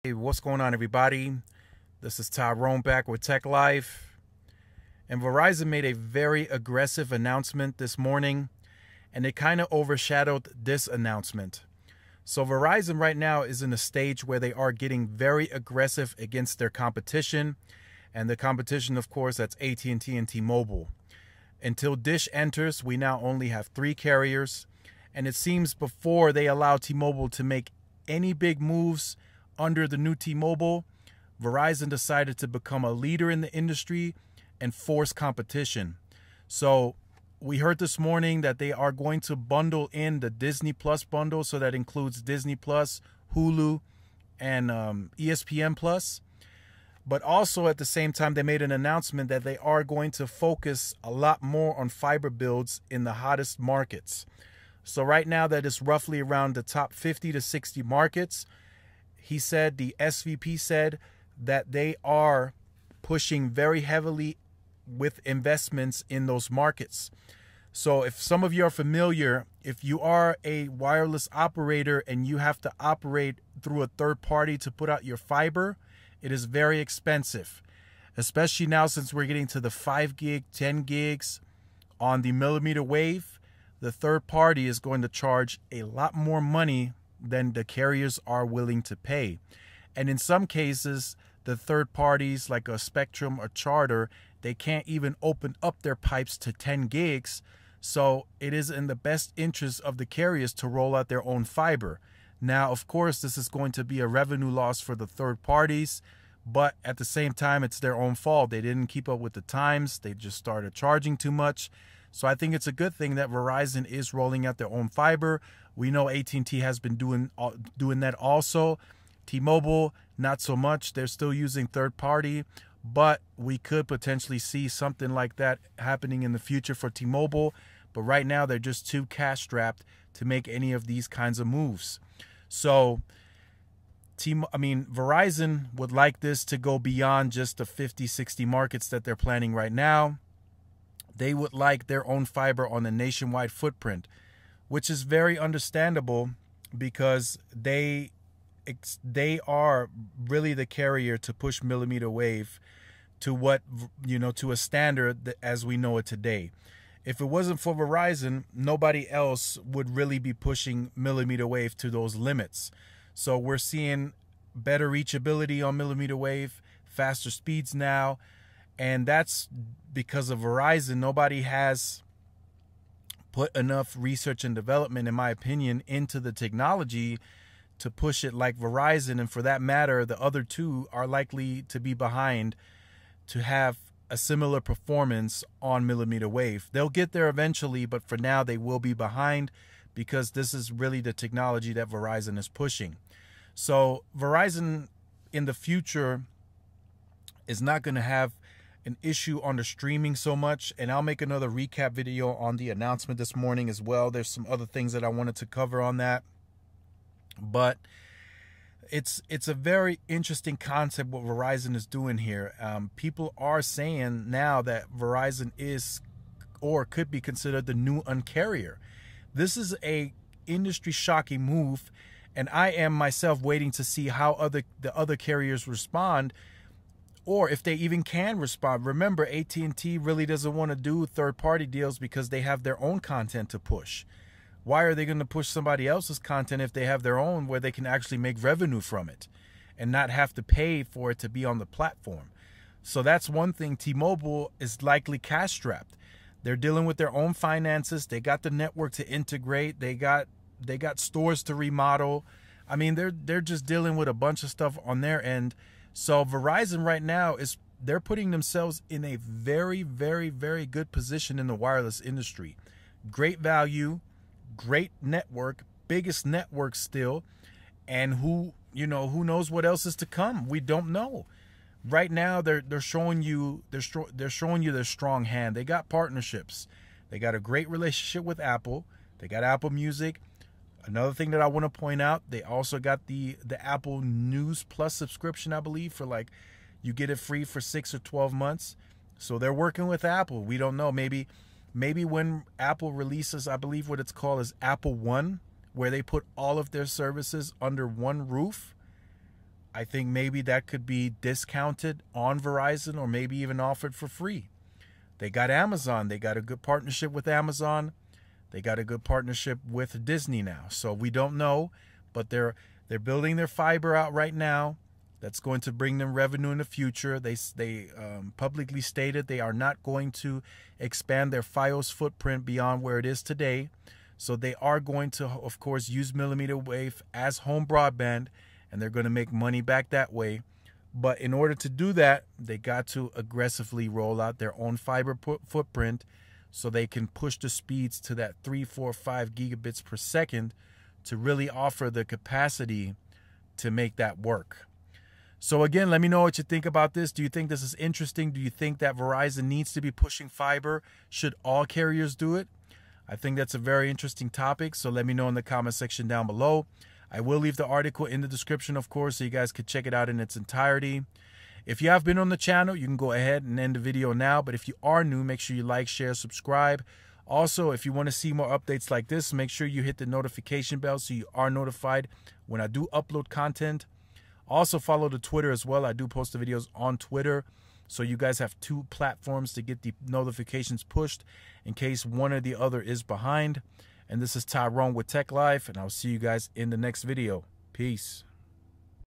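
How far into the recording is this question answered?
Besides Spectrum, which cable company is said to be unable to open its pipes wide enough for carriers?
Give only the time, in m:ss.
1:33.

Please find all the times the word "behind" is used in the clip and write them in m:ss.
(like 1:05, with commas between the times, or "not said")
3:01, 3:08, 6:23.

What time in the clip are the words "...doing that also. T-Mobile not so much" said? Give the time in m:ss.
1:57.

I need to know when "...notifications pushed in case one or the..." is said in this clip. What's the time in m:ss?
6:20.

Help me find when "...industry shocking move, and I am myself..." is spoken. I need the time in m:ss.
3:40.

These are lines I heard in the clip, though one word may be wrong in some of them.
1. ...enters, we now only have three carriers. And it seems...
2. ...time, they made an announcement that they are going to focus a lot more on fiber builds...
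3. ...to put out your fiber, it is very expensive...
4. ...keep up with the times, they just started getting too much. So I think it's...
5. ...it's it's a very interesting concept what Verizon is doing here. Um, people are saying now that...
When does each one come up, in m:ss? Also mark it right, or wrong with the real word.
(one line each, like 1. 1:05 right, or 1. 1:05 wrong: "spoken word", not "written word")
1. 0:22 right
2. 0:48 right
3. 1:14 right
4. 1:48 wrong: "charging", not "getting"
5. 3:28 right.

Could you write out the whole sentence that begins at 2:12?
So T I mean Verizon would like this to go beyond just the 50 60 markets that they're planning right now.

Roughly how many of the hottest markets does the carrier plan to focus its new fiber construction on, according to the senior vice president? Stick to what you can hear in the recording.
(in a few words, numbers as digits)
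50 to 60.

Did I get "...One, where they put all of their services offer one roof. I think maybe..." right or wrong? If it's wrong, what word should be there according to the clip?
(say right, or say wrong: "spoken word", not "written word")
wrong: "under", not "offer".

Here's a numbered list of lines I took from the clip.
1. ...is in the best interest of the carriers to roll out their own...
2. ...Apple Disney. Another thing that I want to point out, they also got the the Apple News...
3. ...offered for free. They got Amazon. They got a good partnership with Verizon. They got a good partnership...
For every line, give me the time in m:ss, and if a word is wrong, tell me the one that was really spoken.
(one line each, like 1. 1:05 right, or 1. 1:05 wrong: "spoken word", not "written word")
1. 1:38 right
2. 4:39 wrong: "Music", not "Disney"
3. 5:03 wrong: "Amazon", not "Verizon".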